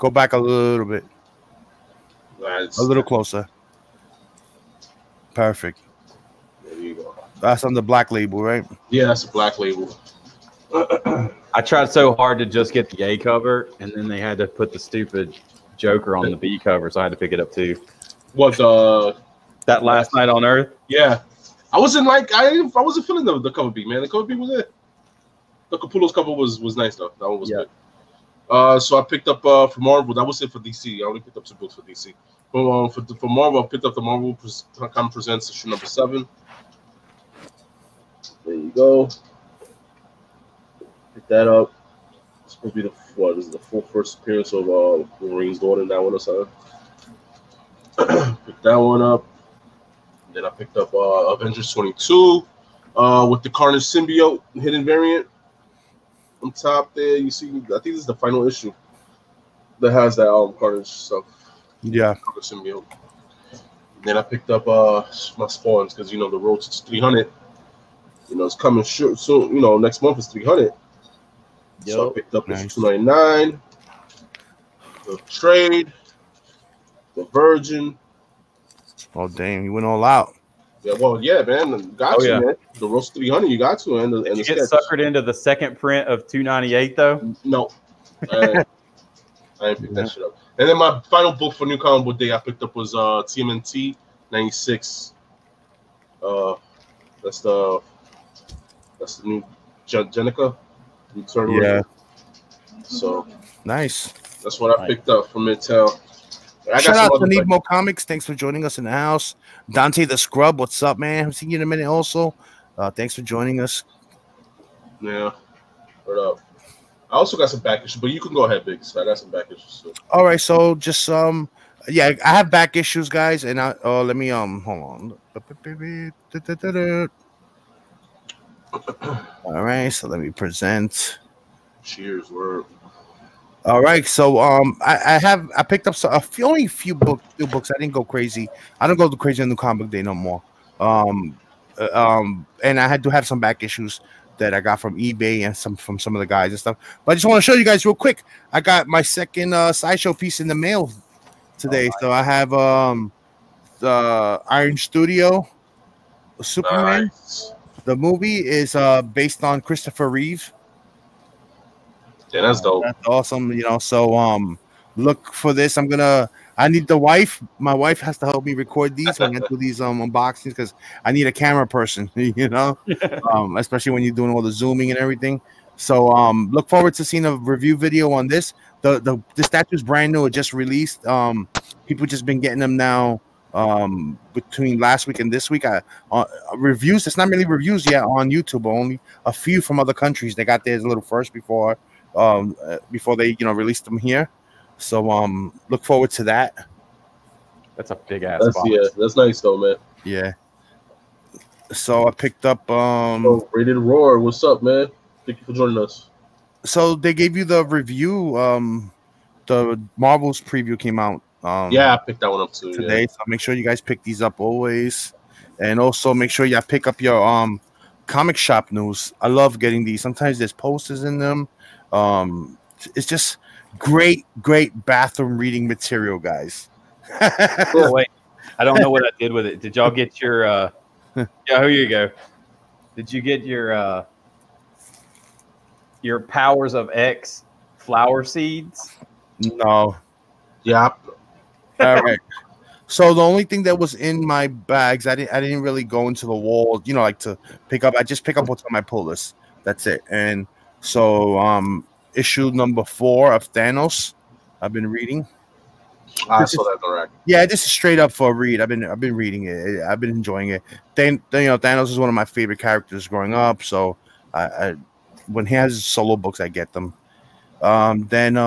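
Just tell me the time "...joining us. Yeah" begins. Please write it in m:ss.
1:53.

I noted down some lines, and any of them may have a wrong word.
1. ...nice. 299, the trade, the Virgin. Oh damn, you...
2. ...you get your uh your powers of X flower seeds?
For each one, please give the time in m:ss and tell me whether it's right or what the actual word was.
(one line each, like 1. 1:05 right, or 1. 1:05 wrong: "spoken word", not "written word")
1. 1:12 right
2. 3:53 right.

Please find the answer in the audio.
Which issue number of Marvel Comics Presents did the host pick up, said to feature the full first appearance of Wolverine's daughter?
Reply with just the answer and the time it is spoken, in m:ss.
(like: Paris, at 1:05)
7, at 0:35.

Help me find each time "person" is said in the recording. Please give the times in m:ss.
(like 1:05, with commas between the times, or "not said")
2:51.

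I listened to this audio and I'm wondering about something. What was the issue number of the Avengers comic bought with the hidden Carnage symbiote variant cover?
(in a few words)
22.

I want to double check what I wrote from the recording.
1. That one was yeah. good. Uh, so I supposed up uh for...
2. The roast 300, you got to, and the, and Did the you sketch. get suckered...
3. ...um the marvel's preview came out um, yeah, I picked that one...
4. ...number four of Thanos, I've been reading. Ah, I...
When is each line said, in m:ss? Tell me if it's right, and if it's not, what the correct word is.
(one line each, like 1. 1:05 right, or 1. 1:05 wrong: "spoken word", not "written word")
1. 0:27 wrong: "picked", not "supposed"
2. 1:22 right
3. 3:28 right
4. 4:12 right.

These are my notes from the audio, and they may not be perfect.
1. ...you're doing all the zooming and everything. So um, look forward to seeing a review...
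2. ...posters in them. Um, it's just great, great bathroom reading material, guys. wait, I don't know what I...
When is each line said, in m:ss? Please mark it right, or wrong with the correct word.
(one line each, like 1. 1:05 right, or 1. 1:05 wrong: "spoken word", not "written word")
1. 2:54 right
2. 3:40 right.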